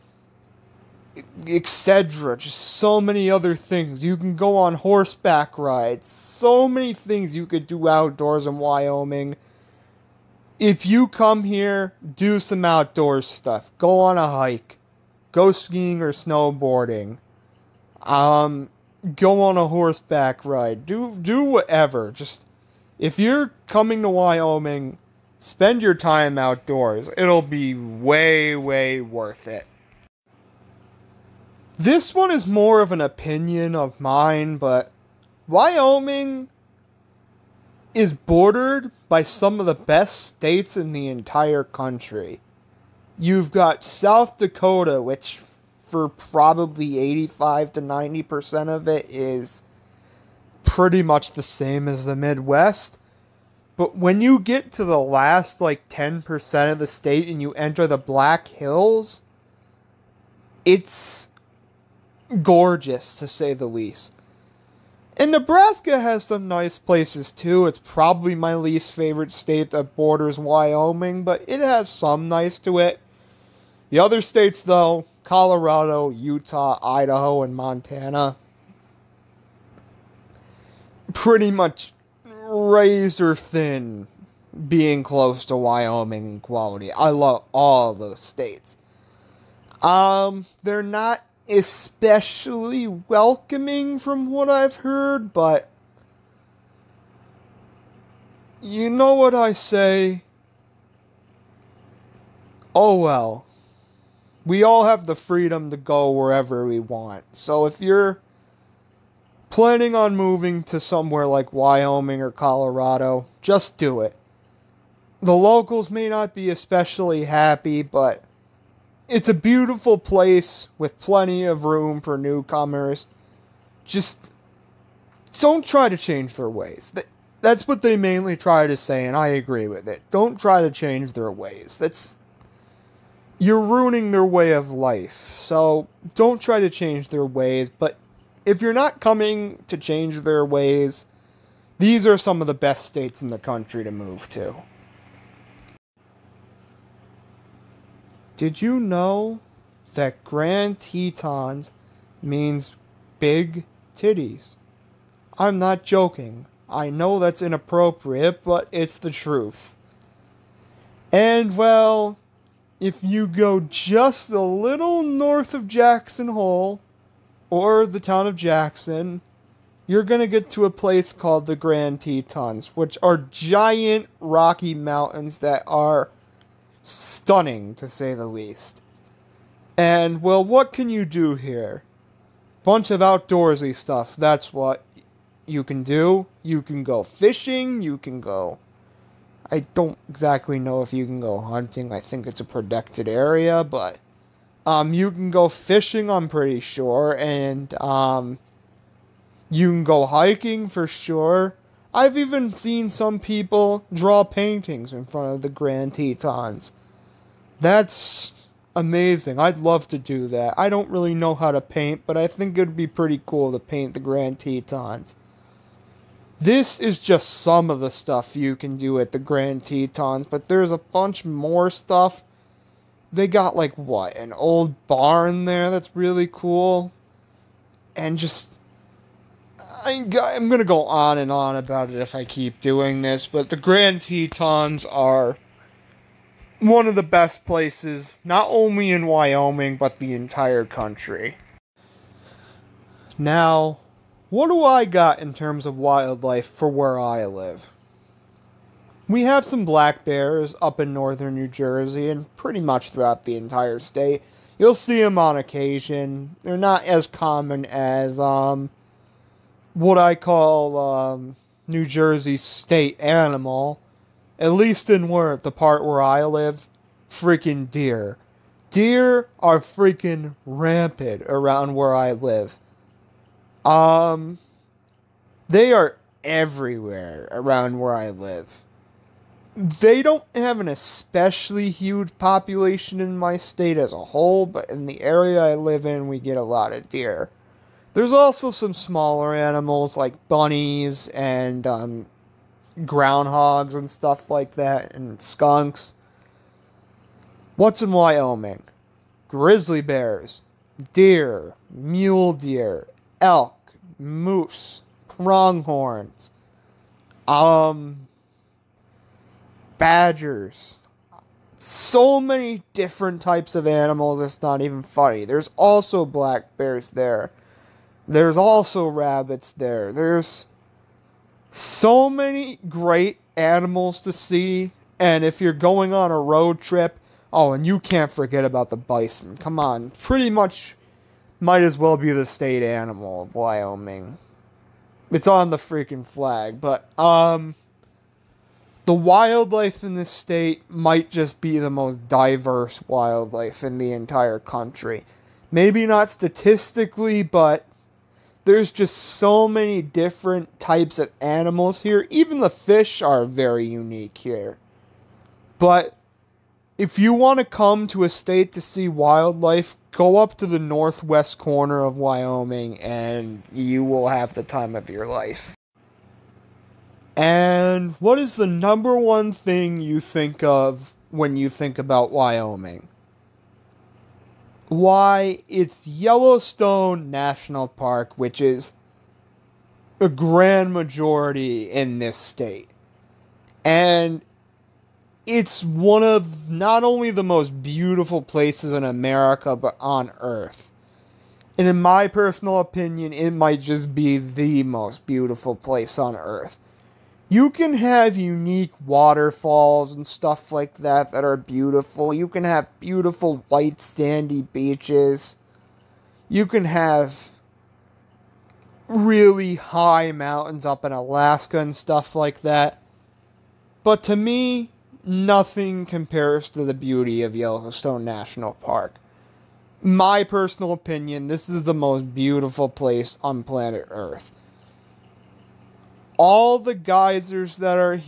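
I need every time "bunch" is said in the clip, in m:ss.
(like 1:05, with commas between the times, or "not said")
3:02, 3:40.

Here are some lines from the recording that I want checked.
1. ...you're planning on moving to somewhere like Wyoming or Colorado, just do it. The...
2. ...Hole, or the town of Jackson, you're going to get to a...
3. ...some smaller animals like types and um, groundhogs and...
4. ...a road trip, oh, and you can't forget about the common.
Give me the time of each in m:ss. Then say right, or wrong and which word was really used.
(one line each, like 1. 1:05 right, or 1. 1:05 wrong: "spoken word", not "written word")
1. 1:47 right
2. 2:46 right
3. 4:48 wrong: "bunnies", not "types"
4. 5:26 wrong: "bison", not "common".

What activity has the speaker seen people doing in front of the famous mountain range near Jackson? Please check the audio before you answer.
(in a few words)
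Draw paintings.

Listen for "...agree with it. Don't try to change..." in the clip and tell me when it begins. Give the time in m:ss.
2:09.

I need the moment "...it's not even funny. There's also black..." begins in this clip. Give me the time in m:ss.
5:14.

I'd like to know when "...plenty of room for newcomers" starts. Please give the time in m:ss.
2:00.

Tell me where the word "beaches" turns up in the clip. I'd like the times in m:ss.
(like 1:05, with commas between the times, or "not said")
6:44.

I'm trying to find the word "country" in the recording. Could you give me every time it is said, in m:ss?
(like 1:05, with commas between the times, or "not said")
0:41, 2:23, 4:00, 5:44.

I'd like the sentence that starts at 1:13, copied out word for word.
The other states, though Colorado, Utah, Idaho, and Montana, pretty much razor thin being close to Wyoming in quality.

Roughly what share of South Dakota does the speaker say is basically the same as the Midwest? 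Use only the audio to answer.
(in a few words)
85 to 90%.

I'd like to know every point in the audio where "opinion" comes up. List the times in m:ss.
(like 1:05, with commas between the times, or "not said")
0:33, 6:32, 7:00.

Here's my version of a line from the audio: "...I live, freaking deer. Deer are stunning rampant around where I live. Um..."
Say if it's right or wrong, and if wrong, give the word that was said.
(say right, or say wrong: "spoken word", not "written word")
wrong: "freaking", not "stunning".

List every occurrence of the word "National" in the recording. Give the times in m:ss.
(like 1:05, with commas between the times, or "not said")
6:17, 6:58.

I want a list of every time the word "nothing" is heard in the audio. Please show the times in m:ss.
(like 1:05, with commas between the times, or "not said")
6:55.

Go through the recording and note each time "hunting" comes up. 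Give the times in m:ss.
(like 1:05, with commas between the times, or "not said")
3:11.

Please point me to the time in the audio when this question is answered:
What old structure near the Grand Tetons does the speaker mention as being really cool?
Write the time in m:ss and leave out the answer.
3:44.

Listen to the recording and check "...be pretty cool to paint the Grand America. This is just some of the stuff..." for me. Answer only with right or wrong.
wrong.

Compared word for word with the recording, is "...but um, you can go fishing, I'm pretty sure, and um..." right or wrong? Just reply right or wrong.
right.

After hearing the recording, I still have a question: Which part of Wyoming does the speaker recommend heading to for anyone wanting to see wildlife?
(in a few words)
Northwest corner.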